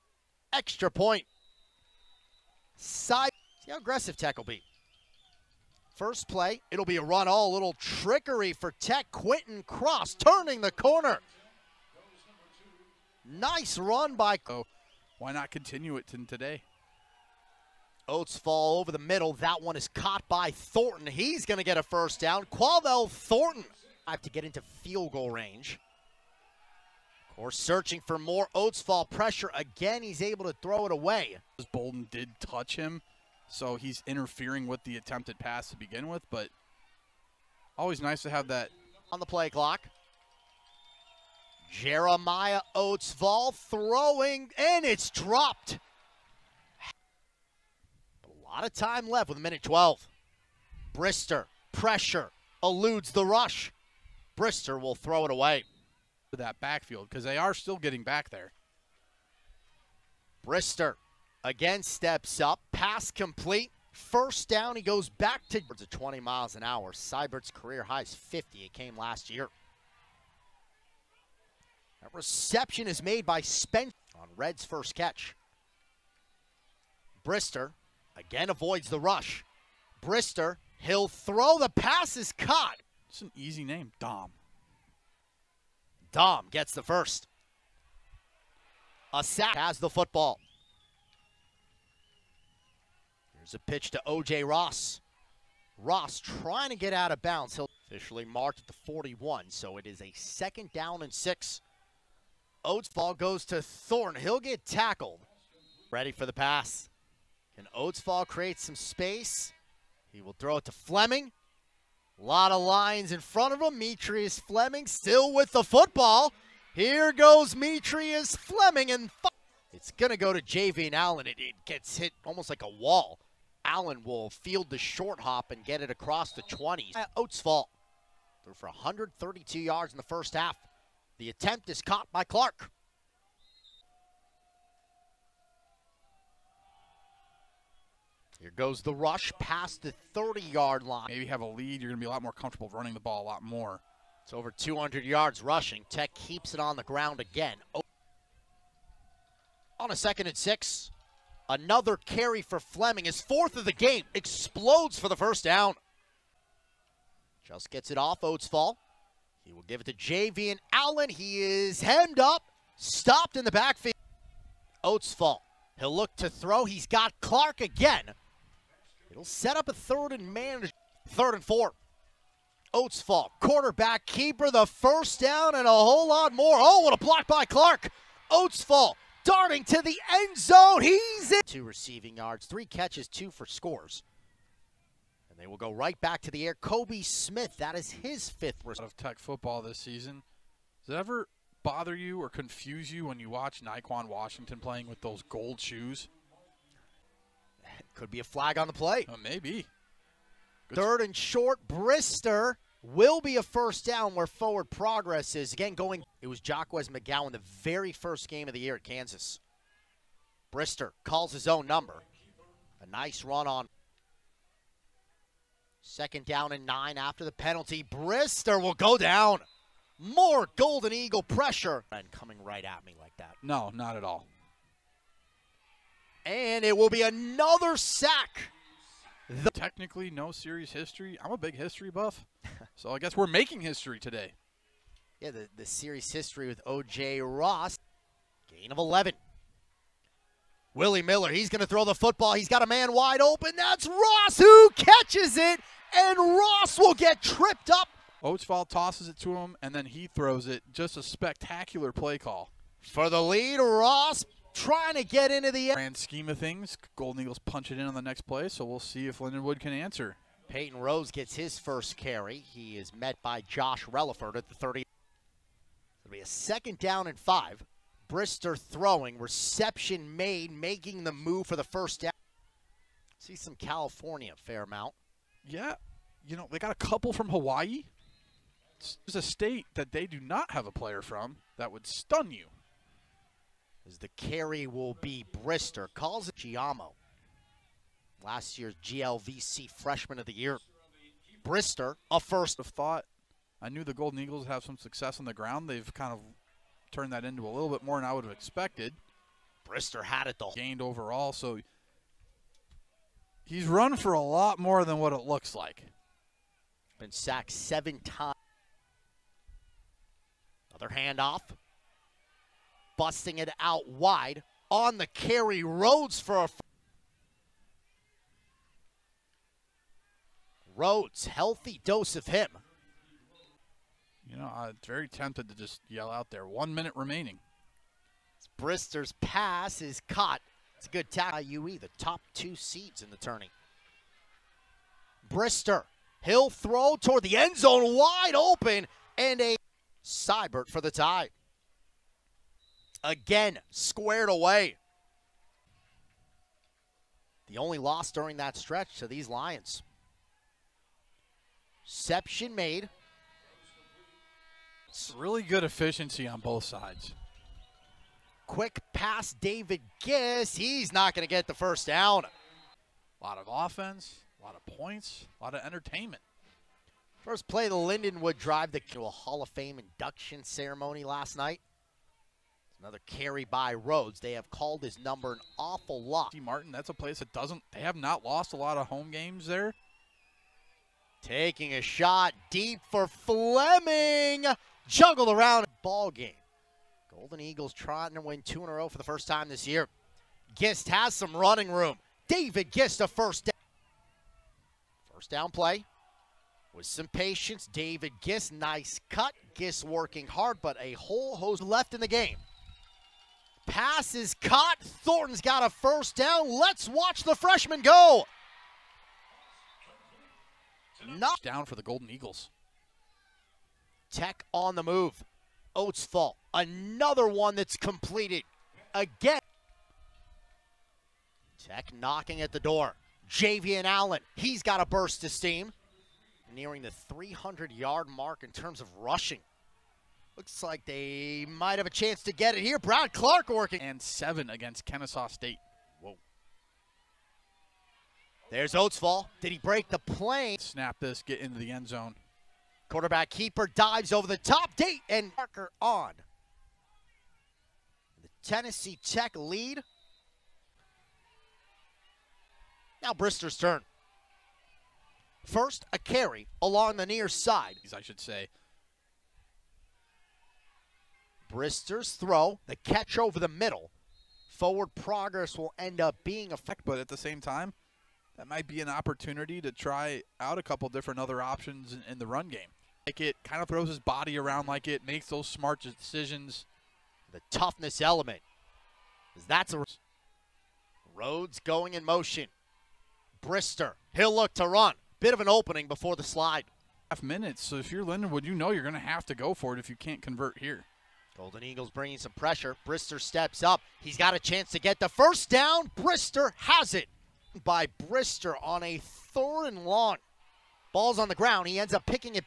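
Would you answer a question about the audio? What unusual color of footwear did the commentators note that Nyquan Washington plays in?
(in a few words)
Gold.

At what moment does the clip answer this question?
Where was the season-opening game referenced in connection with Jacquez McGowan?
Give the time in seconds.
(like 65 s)
208 s.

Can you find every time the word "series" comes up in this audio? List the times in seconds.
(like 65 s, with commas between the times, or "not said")
230 s, 235 s.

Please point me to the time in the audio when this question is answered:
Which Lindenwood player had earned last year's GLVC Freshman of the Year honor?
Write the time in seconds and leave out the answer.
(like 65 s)
286 s.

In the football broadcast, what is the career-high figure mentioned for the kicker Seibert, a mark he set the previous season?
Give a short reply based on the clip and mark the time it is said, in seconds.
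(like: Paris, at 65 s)
50, at 68 s.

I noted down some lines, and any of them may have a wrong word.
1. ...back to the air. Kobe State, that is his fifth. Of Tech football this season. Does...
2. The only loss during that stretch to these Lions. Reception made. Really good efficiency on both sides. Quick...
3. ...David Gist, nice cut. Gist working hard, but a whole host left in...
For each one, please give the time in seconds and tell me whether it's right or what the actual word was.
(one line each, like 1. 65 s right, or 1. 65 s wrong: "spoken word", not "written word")
1. 185 s wrong: "Smith", not "State"
2. 347 s right
3. 397 s right.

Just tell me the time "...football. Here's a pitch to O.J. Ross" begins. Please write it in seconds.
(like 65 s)
89 s.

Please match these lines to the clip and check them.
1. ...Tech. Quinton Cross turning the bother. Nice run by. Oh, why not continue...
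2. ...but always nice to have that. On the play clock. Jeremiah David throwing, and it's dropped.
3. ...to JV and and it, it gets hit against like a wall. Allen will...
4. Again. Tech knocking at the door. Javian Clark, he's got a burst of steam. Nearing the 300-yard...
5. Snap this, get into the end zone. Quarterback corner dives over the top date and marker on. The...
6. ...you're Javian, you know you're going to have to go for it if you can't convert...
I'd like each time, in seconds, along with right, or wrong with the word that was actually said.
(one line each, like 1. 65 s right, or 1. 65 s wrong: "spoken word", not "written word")
1. 8 s wrong: "corner", not "bother"
2. 36 s wrong: "Oatsvall", not "David"
3. 120 s wrong: "almost", not "against"
4. 418 s wrong: "Allen", not "Clark"
5. 440 s wrong: "keeper", not "corner"
6. 487 s wrong: "Lindenwood", not "Javian".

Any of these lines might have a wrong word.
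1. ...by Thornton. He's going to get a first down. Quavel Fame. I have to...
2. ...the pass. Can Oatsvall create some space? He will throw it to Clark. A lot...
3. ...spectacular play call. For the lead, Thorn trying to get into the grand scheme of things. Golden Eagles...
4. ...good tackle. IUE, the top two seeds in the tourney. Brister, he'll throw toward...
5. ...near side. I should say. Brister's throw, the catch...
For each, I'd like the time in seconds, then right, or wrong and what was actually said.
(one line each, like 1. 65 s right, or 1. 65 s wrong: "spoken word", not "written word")
1. 20 s wrong: "Thornton", not "Fame"
2. 106 s wrong: "Fleming", not "Clark"
3. 251 s wrong: "Ross", not "Thorn"
4. 330 s right
5. 457 s right.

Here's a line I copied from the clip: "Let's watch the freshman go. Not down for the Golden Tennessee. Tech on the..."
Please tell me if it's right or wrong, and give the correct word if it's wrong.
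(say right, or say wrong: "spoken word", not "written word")
wrong: "Eagles", not "Tennessee".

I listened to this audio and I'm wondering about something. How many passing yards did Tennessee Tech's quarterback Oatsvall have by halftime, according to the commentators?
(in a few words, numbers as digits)
132.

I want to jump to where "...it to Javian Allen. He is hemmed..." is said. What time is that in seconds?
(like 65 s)
159 s.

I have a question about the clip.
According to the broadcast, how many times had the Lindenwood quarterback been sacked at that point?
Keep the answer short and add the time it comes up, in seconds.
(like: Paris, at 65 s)
7, at 307 s.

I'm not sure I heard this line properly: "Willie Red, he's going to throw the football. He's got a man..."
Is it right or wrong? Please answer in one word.
wrong.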